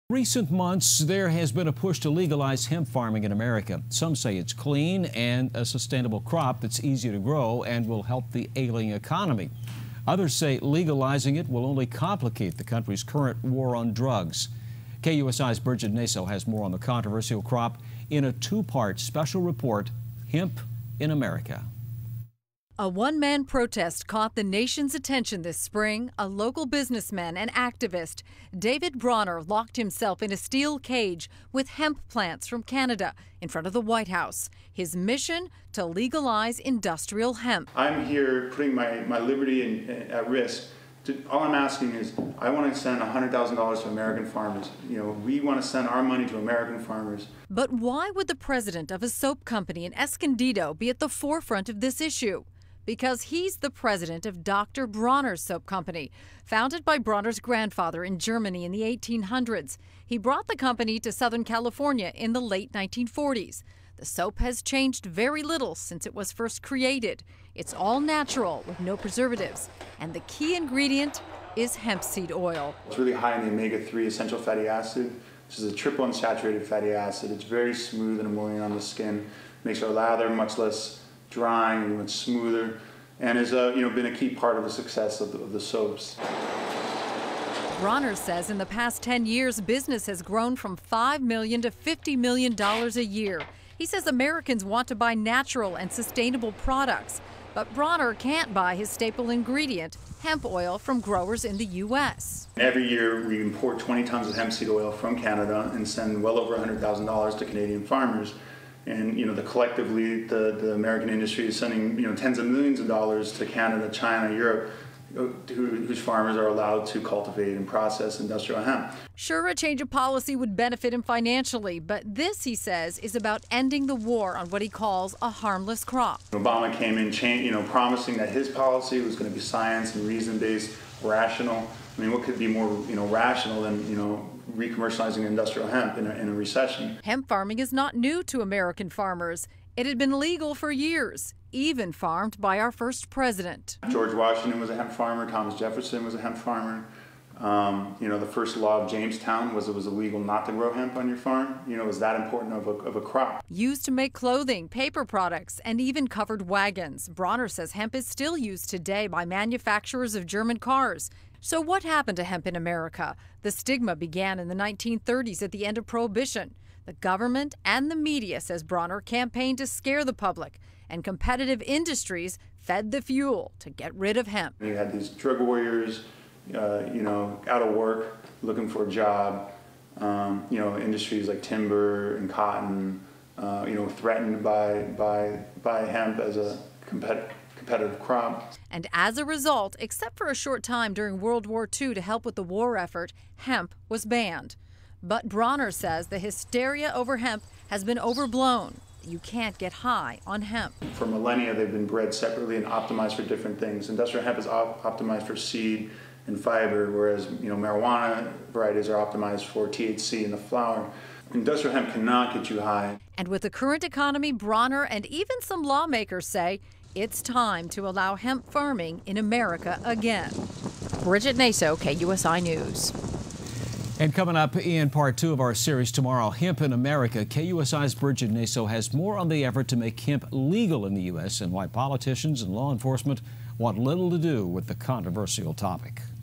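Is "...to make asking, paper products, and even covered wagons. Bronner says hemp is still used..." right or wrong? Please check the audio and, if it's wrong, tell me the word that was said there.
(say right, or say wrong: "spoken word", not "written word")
wrong: "clothing", not "asking".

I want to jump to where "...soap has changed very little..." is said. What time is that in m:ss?
1:04.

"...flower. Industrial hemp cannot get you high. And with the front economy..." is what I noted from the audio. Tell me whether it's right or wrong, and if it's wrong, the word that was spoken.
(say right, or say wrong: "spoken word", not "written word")
wrong: "current", not "front".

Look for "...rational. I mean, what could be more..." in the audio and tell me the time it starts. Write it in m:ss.
2:11.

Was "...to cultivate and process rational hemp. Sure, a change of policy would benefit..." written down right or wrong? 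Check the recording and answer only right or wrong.
wrong.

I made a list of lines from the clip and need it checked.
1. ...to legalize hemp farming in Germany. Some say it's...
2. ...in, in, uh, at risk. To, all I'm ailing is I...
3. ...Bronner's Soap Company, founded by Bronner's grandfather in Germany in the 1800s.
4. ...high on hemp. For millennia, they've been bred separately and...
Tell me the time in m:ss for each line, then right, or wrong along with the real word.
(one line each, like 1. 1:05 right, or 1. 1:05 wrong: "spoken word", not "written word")
1. 0:02 wrong: "America", not "Germany"
2. 0:39 wrong: "asking", not "ailing"
3. 0:54 right
4. 3:19 right.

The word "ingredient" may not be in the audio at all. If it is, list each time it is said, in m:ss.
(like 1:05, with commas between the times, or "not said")
1:10, 1:39.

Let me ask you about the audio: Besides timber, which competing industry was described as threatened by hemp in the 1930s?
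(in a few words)
cotton.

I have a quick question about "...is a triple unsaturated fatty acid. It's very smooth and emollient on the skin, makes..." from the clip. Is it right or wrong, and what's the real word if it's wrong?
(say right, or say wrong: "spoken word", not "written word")
right.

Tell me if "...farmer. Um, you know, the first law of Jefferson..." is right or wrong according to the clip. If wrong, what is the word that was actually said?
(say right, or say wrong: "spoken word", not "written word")
wrong: "Jamestown", not "Jefferson".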